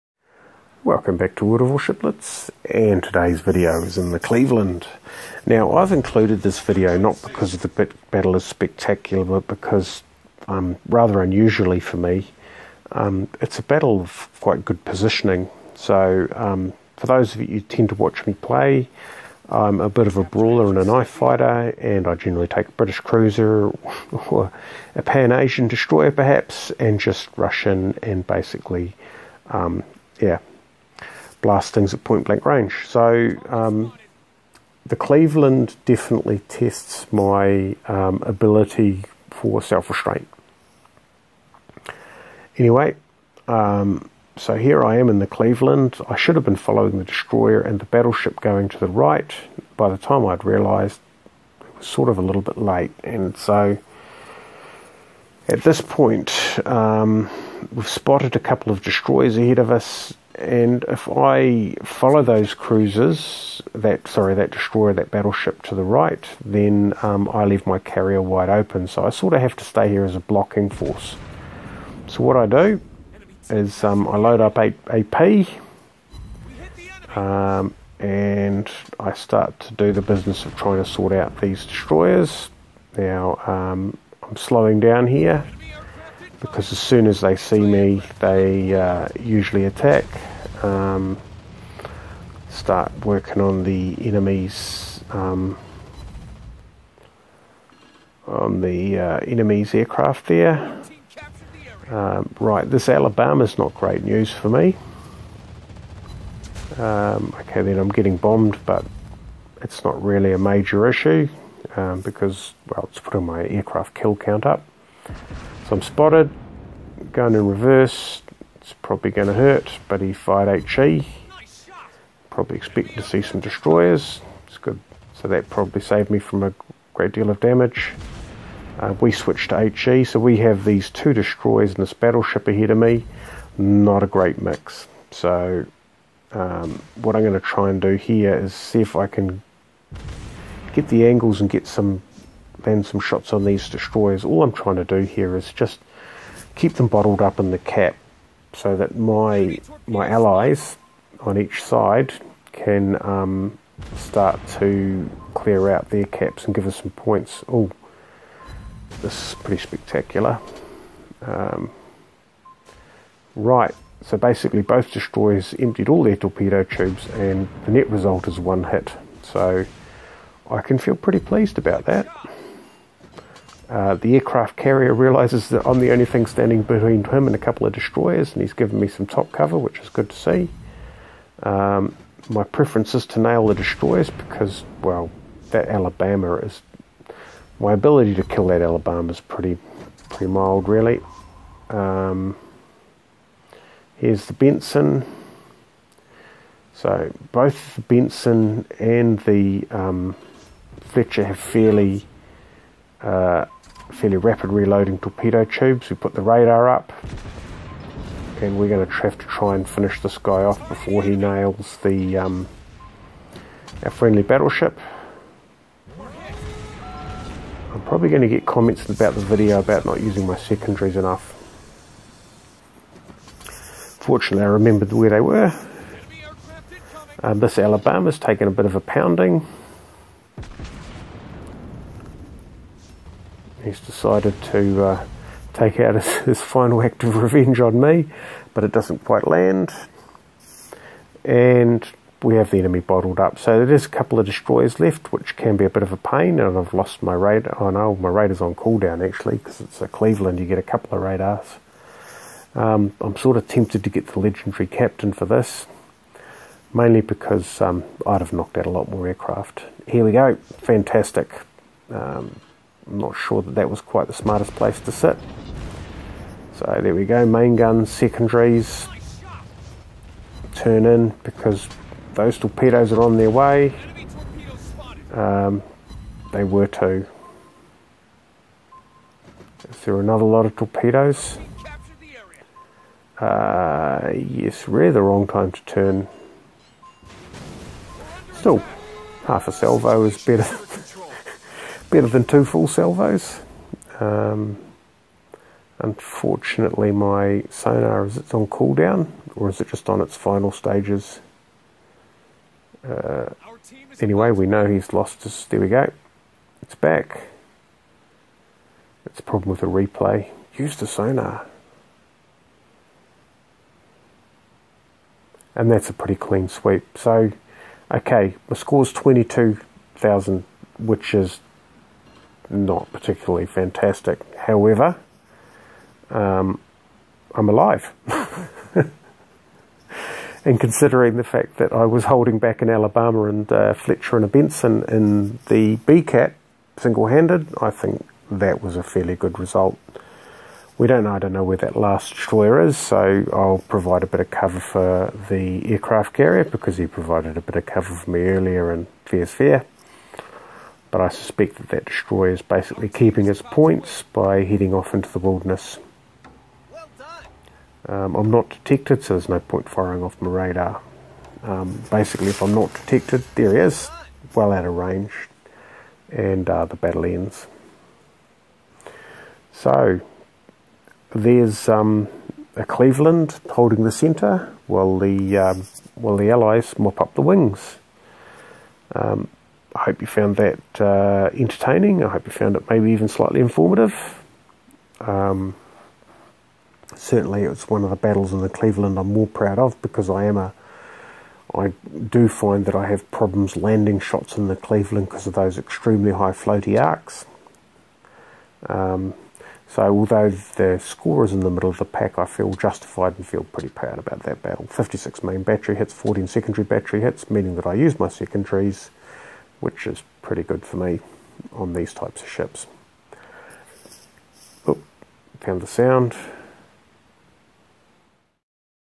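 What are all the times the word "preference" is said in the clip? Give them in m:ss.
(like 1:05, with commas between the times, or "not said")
3:02.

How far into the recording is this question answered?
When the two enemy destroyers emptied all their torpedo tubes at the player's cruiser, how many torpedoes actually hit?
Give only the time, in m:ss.
2:48.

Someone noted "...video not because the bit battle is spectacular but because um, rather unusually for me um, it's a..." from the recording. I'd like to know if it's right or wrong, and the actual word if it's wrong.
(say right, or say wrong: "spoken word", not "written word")
right.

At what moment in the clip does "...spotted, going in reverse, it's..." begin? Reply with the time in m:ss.
1:55.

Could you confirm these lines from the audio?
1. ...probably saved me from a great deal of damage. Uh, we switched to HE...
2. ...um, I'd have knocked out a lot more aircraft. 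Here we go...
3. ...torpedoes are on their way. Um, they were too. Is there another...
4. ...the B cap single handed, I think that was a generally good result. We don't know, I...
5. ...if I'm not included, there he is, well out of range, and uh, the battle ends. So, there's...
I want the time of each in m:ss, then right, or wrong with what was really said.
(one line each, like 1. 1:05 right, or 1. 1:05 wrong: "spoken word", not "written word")
1. 2:05 right
2. 4:17 right
3. 4:32 right
4. 5:35 wrong: "fairly", not "generally"
5. 6:02 wrong: "detected", not "included".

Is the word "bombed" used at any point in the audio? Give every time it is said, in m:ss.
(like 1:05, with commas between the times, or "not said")
1:48.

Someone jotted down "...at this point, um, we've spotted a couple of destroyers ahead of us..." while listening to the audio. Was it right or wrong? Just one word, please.
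right.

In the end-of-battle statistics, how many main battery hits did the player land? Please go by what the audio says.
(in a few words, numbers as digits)
56.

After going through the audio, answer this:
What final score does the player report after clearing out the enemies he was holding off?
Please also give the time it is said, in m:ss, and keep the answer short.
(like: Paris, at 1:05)
22,000, at 5:18.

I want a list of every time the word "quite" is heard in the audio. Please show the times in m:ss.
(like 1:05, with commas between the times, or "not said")
0:14, 3:59, 4:23.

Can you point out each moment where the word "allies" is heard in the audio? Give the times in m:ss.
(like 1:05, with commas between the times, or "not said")
2:30, 6:16.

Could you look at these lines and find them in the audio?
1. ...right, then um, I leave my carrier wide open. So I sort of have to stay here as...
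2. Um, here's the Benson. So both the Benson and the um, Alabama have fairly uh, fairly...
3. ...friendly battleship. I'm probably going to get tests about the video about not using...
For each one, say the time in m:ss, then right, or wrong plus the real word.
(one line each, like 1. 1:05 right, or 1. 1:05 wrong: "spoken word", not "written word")
1. 1:05 right
2. 3:11 wrong: "Fletcher", not "Alabama"
3. 3:33 wrong: "comments", not "tests".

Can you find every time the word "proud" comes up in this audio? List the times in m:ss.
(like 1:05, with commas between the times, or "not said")
6:29, 6:43.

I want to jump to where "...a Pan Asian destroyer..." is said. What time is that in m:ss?
0:24.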